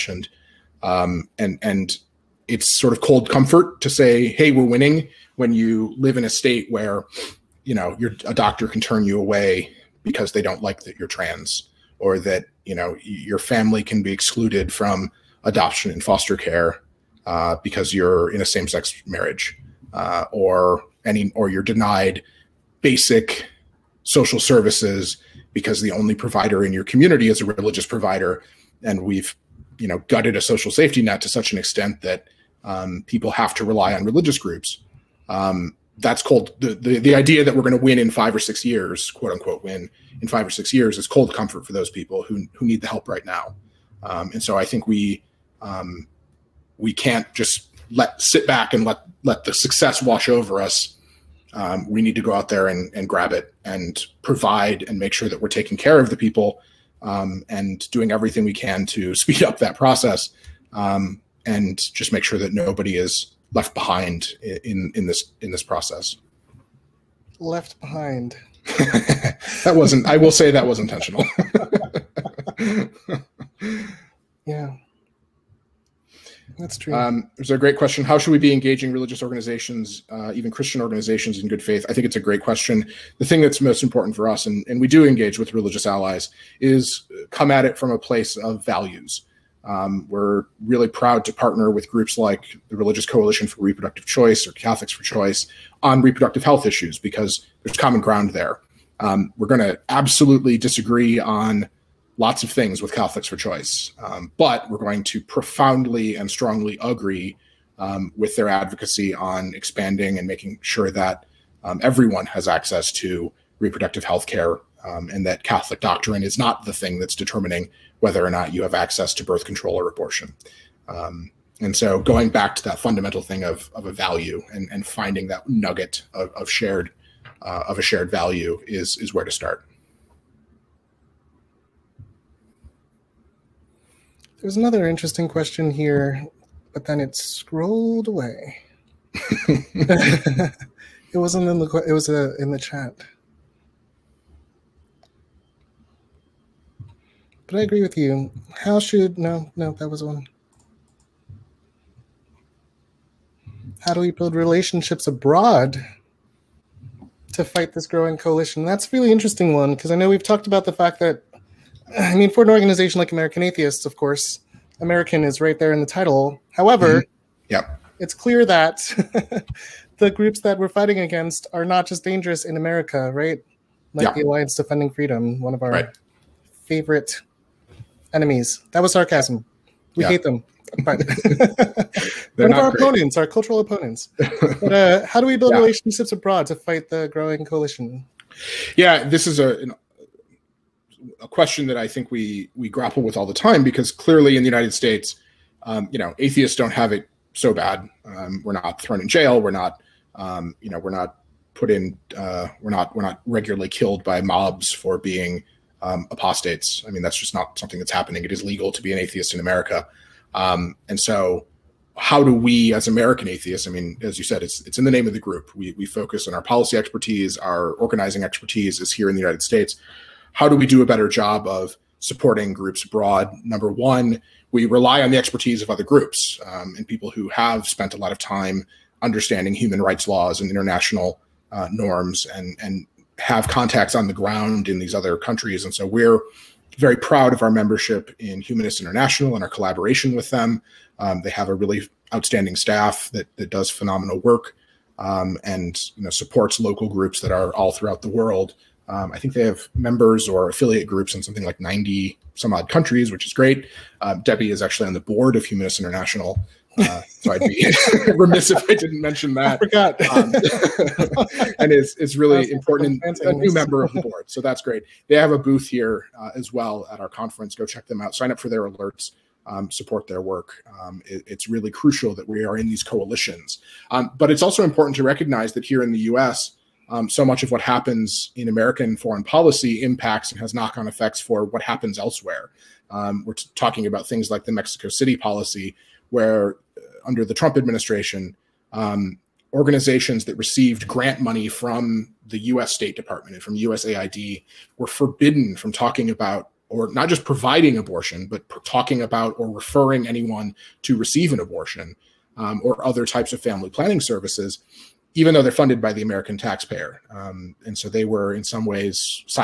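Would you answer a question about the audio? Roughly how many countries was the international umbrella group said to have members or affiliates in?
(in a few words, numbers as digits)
90.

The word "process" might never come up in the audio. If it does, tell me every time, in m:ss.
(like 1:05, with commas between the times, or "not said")
0:59, 1:05.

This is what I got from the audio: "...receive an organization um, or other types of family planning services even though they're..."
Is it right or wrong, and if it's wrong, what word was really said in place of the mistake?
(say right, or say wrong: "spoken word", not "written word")
wrong: "abortion", not "organization".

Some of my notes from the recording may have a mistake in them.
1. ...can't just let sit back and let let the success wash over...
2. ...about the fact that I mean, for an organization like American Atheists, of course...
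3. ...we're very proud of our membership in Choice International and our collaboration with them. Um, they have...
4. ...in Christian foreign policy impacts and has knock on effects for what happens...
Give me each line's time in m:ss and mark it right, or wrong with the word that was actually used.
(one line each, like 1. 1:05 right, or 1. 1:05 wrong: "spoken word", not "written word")
1. 0:46 right
2. 2:40 right
3. 3:55 wrong: "Humanist", not "Choice"
4. 4:38 wrong: "American", not "Christian".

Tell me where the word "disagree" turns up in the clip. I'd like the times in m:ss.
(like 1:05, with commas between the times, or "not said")
1:40.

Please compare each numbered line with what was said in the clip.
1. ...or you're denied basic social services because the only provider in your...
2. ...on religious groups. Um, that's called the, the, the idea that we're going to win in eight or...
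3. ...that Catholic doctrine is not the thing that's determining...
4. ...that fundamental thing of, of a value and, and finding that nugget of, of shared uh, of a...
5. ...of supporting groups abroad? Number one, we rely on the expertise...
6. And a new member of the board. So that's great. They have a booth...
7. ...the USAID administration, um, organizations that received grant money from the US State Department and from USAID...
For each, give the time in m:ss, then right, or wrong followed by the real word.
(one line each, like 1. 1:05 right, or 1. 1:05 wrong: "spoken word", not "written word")
1. 0:21 right
2. 0:33 wrong: "five", not "eight"
3. 1:55 right
4. 2:02 right
5. 3:41 right
6. 4:23 right
7. 4:47 wrong: "Trump", not "USAID".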